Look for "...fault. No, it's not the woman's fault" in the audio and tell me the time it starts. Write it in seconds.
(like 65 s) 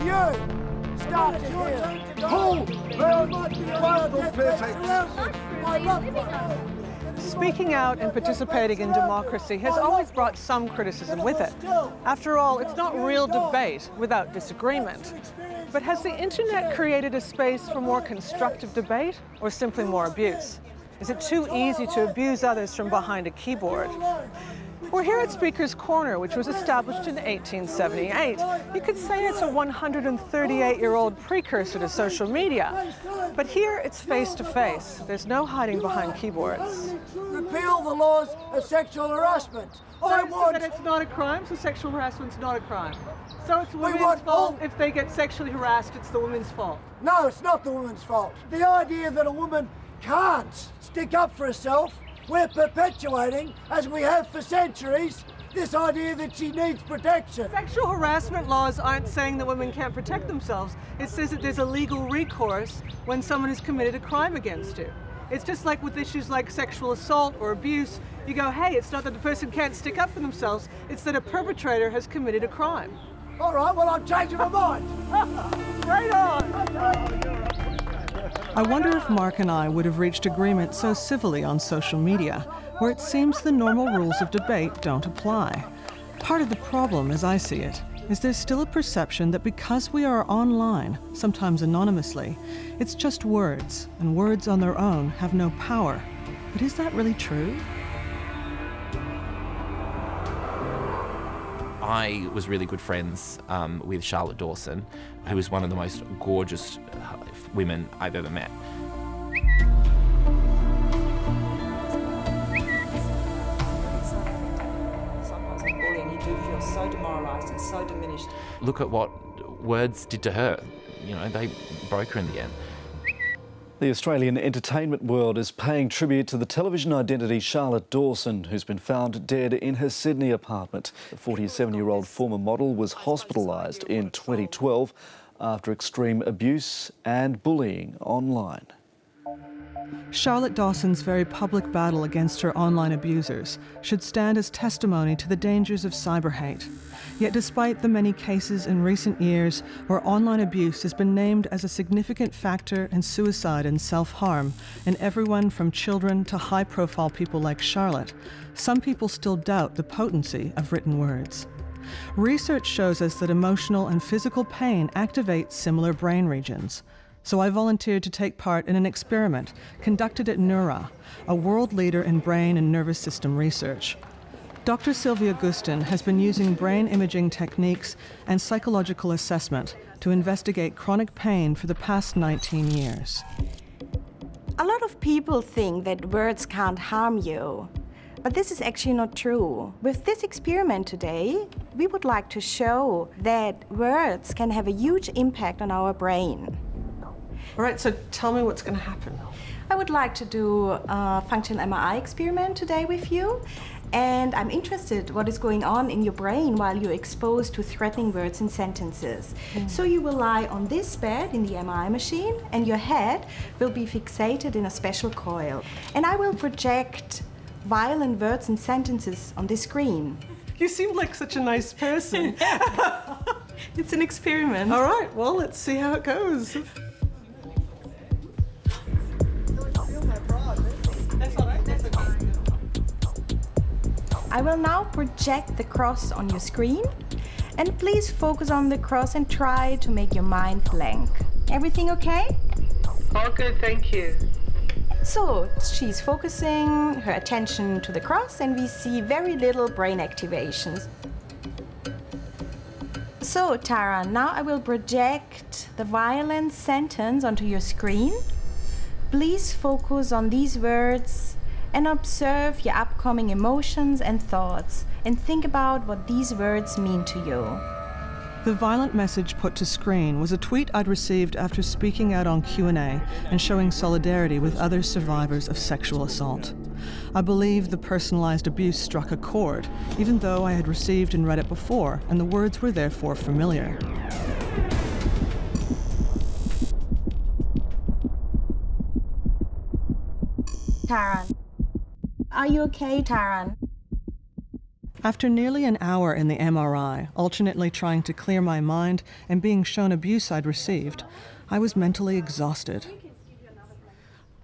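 46 s.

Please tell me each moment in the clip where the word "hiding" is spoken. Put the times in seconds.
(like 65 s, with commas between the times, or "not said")
35 s.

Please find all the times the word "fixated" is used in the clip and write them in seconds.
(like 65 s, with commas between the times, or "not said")
213 s.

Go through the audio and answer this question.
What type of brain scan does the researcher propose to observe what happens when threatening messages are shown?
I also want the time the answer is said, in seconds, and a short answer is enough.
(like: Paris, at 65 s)
functional MRI, at 201 s.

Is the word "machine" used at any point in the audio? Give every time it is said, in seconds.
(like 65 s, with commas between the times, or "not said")
211 s.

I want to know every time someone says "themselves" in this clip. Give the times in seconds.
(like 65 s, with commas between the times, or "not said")
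60 s, 70 s.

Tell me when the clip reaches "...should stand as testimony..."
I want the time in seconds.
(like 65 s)
143 s.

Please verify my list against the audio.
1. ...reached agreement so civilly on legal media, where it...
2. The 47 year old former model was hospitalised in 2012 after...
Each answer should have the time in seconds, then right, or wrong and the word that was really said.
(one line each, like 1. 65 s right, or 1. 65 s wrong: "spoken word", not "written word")
1. 79 s wrong: "social", not "legal"
2. 131 s right.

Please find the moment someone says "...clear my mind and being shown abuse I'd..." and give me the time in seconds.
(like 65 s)
298 s.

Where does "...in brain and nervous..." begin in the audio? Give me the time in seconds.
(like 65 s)
172 s.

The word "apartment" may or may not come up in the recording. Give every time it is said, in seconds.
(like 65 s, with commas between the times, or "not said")
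130 s.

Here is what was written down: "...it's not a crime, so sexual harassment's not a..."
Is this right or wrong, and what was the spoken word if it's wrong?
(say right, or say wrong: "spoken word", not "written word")
right.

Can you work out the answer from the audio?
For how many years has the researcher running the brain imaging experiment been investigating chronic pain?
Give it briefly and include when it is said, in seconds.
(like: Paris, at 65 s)
19, at 182 s.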